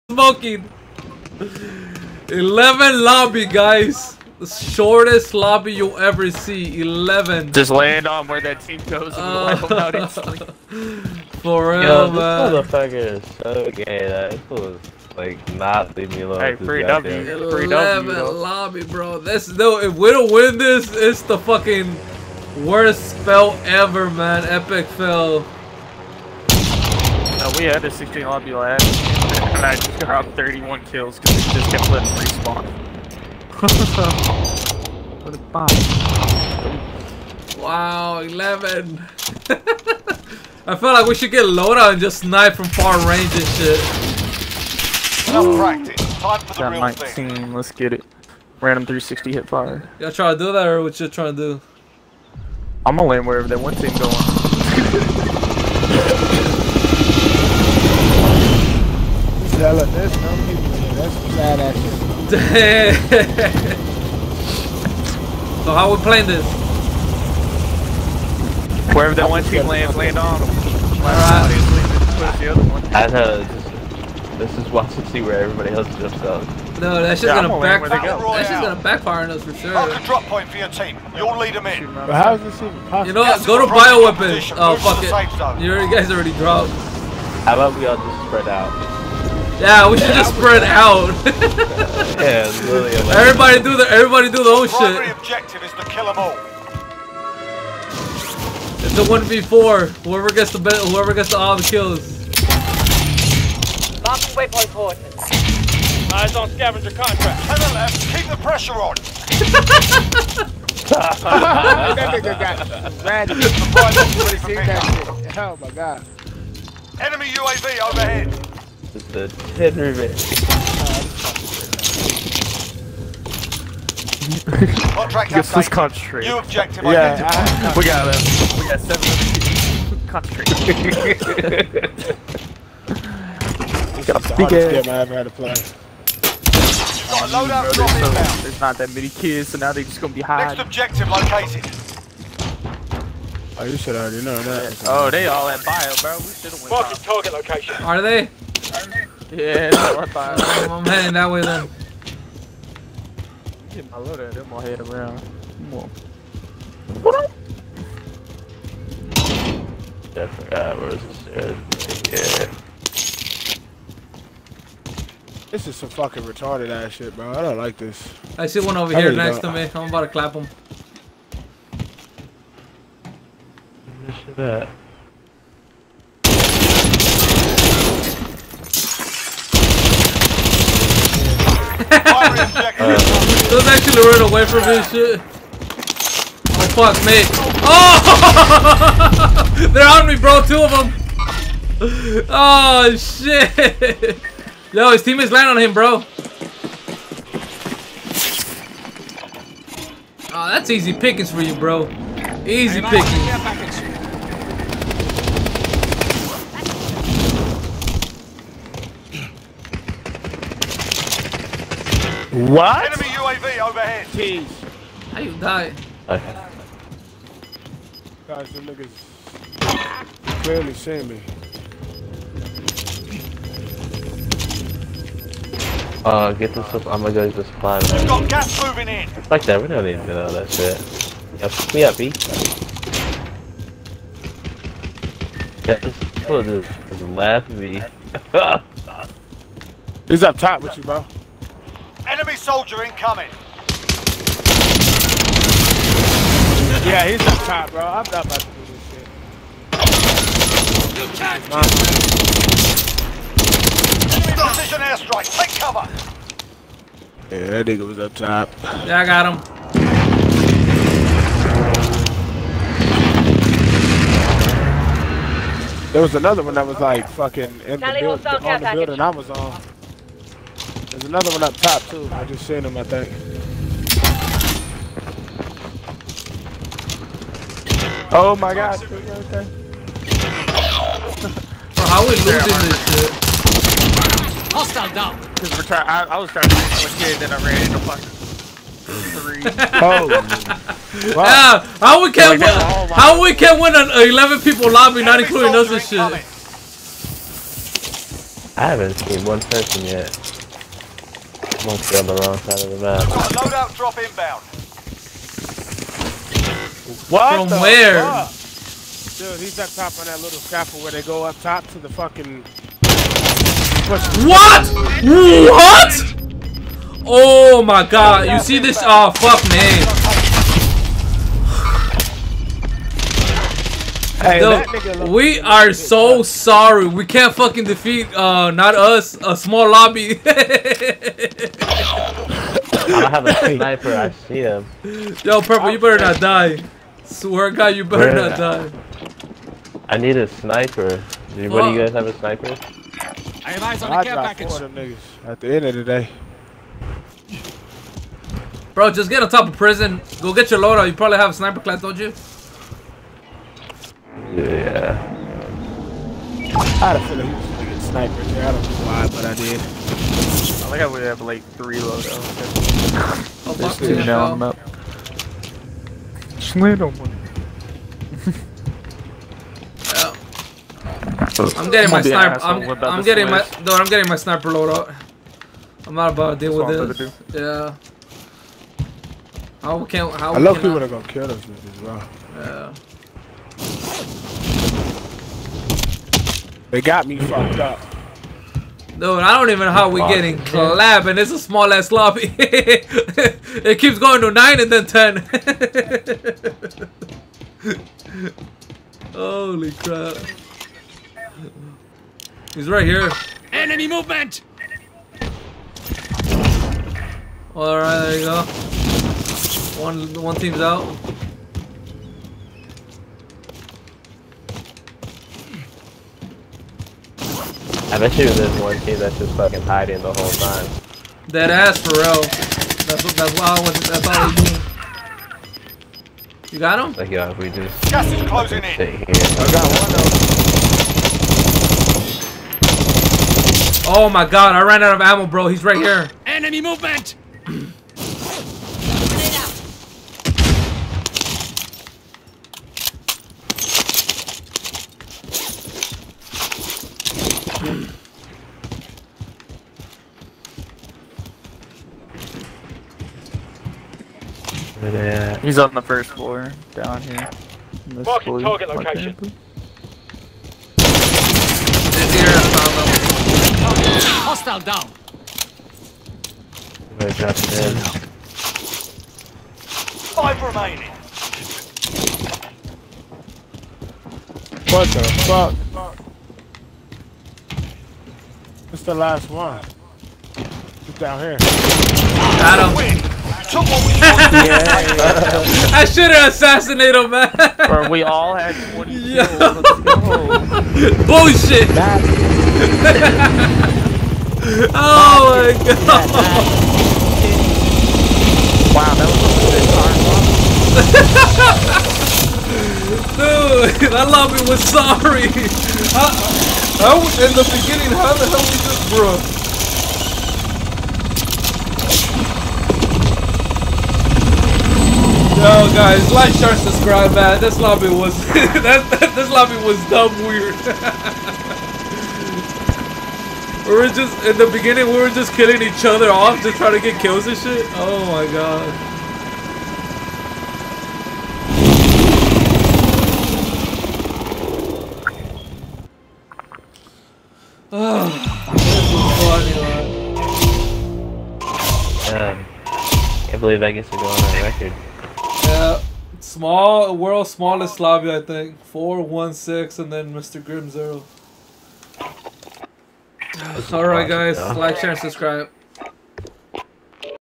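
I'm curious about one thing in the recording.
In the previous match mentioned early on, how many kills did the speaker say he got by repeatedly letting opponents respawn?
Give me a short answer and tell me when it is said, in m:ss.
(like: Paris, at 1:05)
31, at 0:30.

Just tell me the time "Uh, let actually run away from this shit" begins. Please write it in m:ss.
3:02.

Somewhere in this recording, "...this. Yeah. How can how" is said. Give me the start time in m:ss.
6:16.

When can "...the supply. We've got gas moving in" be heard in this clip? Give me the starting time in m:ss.
3:47.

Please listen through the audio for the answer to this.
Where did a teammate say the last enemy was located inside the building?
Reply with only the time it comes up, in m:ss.
7:35.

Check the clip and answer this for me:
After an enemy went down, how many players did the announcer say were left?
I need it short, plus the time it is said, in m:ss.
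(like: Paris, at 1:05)
5, at 7:50.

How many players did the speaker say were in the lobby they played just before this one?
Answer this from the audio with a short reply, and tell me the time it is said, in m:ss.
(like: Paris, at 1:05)
16, at 0:27.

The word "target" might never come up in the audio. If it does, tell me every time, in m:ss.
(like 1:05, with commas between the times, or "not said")
2:26, 7:38.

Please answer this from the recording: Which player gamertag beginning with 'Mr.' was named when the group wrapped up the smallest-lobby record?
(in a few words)
Mr. Grim Zero.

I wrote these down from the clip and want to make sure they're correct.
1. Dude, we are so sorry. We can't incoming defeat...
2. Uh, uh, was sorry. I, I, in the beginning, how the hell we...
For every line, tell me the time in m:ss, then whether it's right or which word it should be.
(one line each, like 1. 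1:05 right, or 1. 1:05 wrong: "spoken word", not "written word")
1. 5:24 wrong: "fucking", not "incoming"
2. 8:24 right.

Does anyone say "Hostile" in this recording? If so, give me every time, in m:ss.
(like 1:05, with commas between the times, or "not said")
4:44, 7:44.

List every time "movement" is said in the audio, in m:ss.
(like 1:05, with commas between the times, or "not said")
6:43, 7:16.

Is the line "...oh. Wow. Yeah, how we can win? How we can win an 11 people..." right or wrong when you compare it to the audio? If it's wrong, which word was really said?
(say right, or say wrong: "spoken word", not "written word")
right.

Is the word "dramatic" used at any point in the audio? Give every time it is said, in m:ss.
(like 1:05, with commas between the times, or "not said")
not said.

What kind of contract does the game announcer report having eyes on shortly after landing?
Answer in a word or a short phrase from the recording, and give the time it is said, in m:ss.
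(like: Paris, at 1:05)
Scavenger contract, at 1:46.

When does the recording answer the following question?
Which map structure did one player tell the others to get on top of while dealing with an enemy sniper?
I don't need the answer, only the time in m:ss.
5:49.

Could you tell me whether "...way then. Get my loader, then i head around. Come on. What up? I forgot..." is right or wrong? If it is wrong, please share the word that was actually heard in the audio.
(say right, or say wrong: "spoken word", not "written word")
right.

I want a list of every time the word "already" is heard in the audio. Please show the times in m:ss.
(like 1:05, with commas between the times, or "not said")
1:26, 2:23.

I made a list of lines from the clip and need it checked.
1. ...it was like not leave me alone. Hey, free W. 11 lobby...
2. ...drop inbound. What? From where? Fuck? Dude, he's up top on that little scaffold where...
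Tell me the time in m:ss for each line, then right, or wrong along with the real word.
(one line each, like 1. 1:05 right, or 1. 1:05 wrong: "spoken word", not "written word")
1. 0:14 right
2. 5:03 right.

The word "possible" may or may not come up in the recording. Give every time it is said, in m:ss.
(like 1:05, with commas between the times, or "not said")
1:22.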